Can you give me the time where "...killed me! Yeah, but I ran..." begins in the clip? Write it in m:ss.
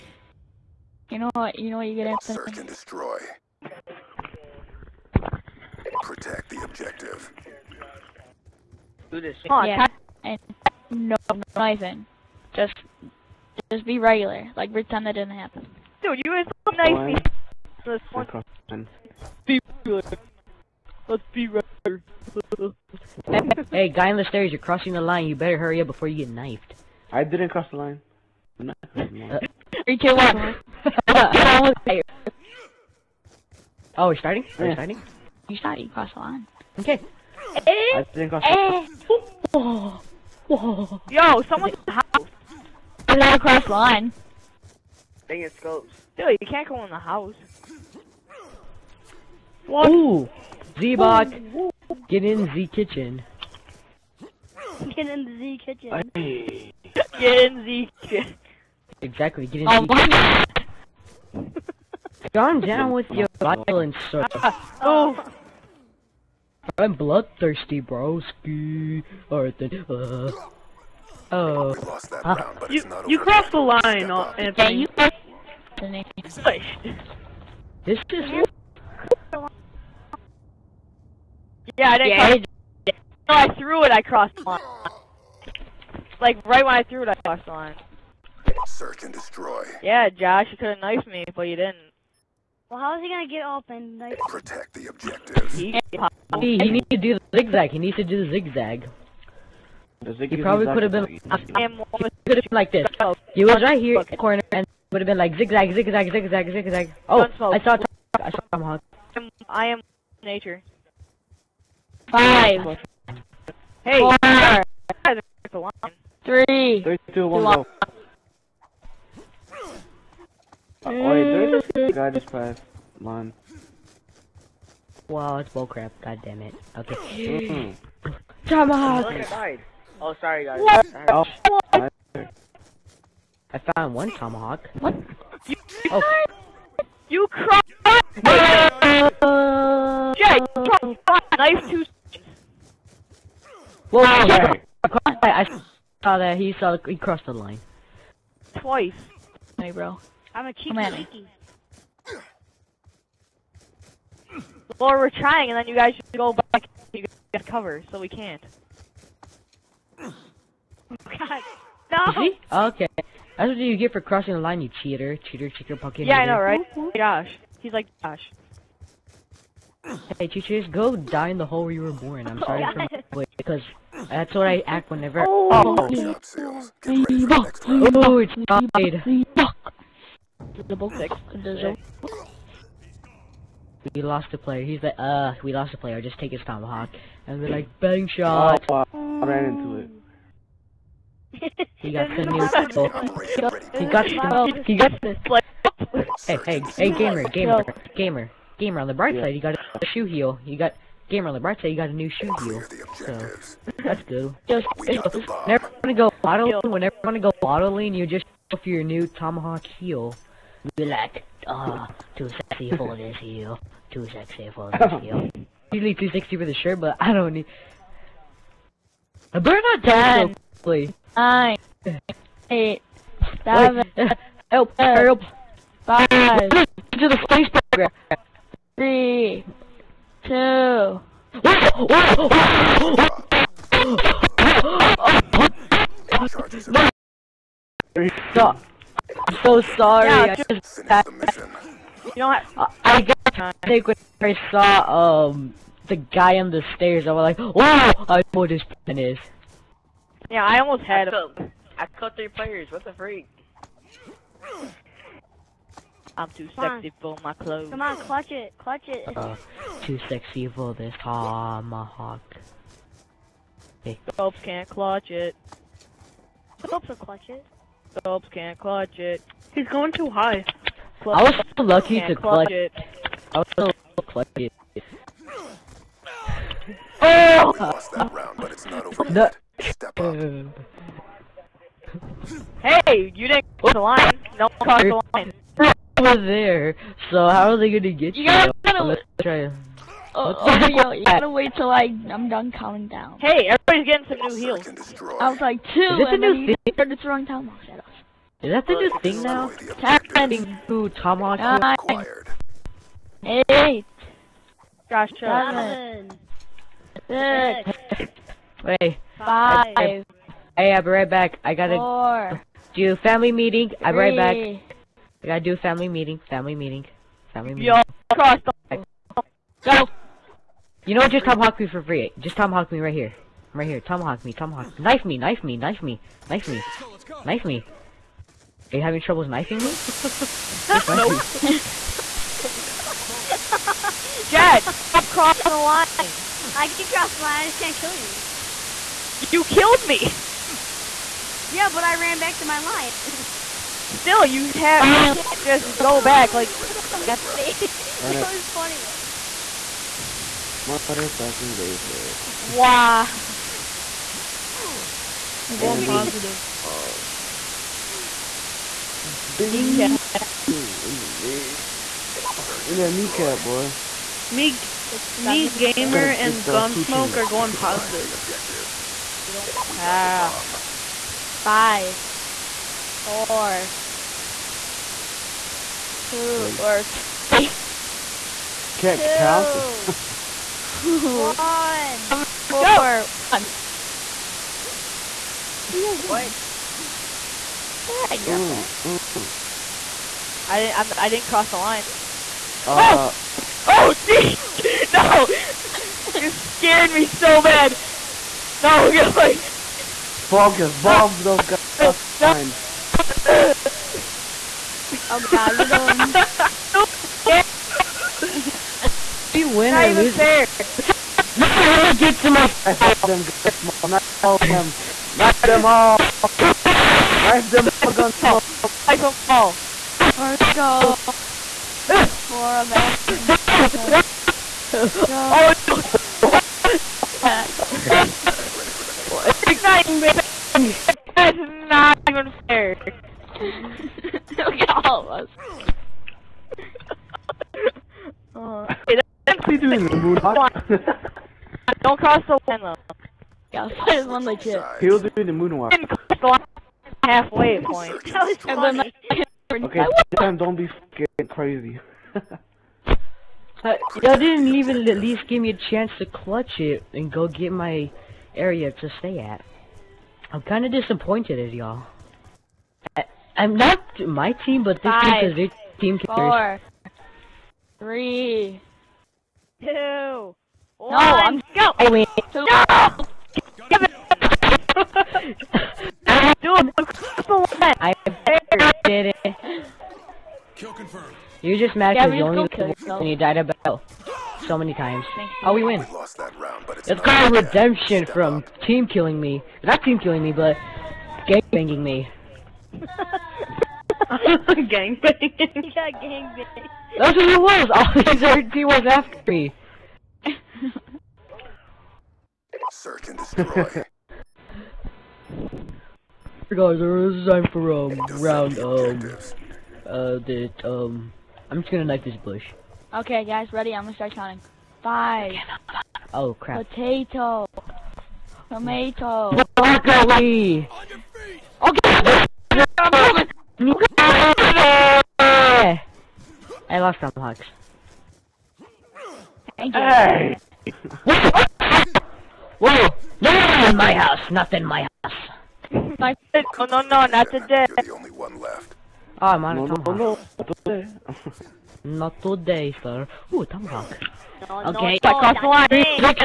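5:39.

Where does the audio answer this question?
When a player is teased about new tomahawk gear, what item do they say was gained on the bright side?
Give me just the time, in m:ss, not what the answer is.
3:21.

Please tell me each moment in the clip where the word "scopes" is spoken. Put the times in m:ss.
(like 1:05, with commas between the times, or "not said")
0:45.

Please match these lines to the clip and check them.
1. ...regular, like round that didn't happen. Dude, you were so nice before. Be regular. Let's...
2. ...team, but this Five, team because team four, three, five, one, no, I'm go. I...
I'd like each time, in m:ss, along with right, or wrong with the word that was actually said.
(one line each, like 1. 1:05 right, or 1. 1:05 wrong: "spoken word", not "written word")
1. 0:13 wrong: "pretend", not "round"
2. 7:44 wrong: "two", not "five".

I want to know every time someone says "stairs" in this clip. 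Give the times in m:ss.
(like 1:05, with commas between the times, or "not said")
0:24, 4:06.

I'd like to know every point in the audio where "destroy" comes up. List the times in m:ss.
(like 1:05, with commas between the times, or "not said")
0:02, 1:29, 8:23.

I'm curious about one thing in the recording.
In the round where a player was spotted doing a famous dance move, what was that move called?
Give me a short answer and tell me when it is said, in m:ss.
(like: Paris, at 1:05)
moonwalk, at 7:25.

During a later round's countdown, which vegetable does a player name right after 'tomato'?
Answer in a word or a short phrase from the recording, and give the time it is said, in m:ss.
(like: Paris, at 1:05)
broccoli, at 8:39.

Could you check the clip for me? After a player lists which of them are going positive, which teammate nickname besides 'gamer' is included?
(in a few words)
smoke.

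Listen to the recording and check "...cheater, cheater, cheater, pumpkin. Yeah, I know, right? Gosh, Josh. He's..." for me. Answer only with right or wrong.
right.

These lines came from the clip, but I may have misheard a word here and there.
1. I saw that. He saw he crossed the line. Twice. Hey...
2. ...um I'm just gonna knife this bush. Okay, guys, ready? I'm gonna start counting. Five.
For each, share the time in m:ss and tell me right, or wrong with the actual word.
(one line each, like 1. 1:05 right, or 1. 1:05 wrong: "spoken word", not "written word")
1. 2:25 right
2. 8:30 right.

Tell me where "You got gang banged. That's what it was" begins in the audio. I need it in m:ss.
8:15.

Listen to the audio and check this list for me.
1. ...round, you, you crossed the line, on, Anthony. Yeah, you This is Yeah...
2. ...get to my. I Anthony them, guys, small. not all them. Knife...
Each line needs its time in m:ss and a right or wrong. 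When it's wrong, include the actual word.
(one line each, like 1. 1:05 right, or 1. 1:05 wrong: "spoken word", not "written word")
1. 1:12 right
2. 6:51 wrong: "Knife", not "Anthony".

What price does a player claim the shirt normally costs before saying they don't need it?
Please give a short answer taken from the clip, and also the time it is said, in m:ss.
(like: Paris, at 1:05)
260, at 3:35.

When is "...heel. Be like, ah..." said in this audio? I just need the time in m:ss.
3:29.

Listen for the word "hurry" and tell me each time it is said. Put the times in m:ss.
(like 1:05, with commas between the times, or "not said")
0:25.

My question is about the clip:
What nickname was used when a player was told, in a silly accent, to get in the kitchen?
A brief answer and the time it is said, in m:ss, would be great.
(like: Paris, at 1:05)
Z-Bot, at 0:50.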